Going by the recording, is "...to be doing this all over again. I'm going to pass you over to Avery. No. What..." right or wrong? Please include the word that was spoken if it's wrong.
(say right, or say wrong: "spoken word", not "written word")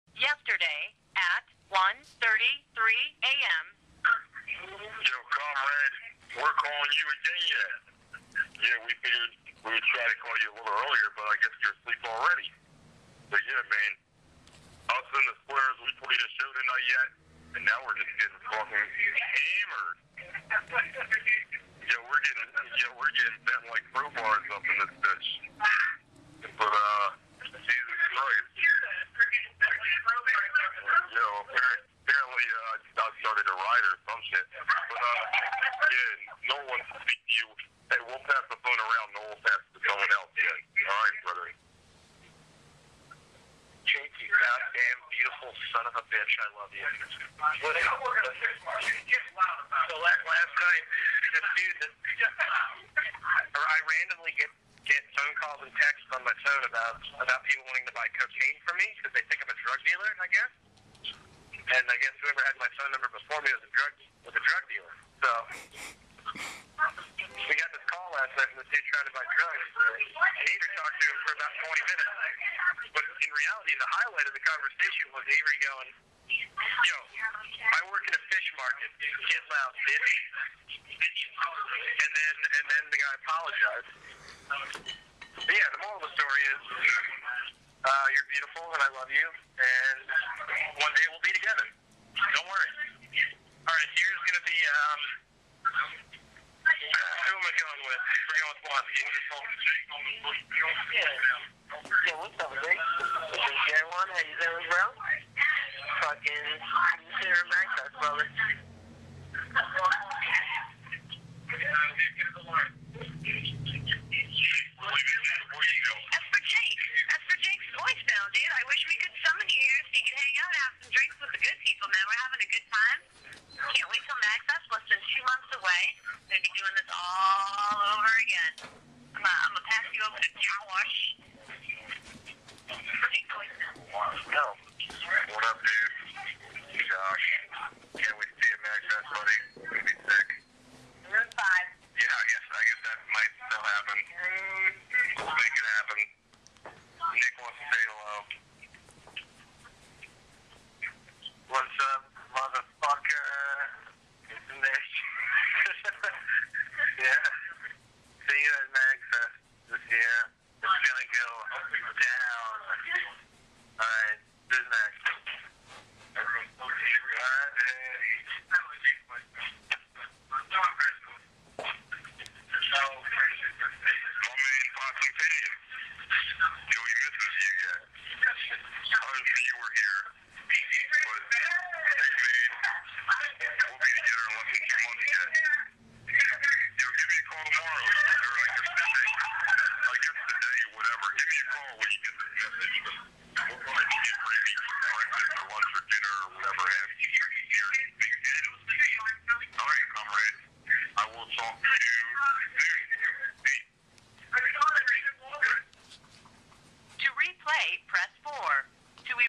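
wrong: "Josh", not "Avery".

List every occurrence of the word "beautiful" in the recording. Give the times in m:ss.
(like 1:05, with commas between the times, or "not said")
0:45, 1:28.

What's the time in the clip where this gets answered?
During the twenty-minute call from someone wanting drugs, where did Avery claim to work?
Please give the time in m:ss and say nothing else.
1:18.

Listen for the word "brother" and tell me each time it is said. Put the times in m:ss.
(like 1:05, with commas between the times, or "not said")
0:41, 1:48.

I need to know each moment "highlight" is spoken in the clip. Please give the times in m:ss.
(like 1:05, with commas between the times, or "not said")
1:13.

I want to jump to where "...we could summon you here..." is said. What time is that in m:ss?
1:58.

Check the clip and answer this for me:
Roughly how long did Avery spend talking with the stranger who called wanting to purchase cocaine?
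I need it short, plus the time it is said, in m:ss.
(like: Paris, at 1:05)
20 minutes, at 1:11.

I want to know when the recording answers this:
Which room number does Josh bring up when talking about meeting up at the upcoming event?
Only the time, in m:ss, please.
2:21.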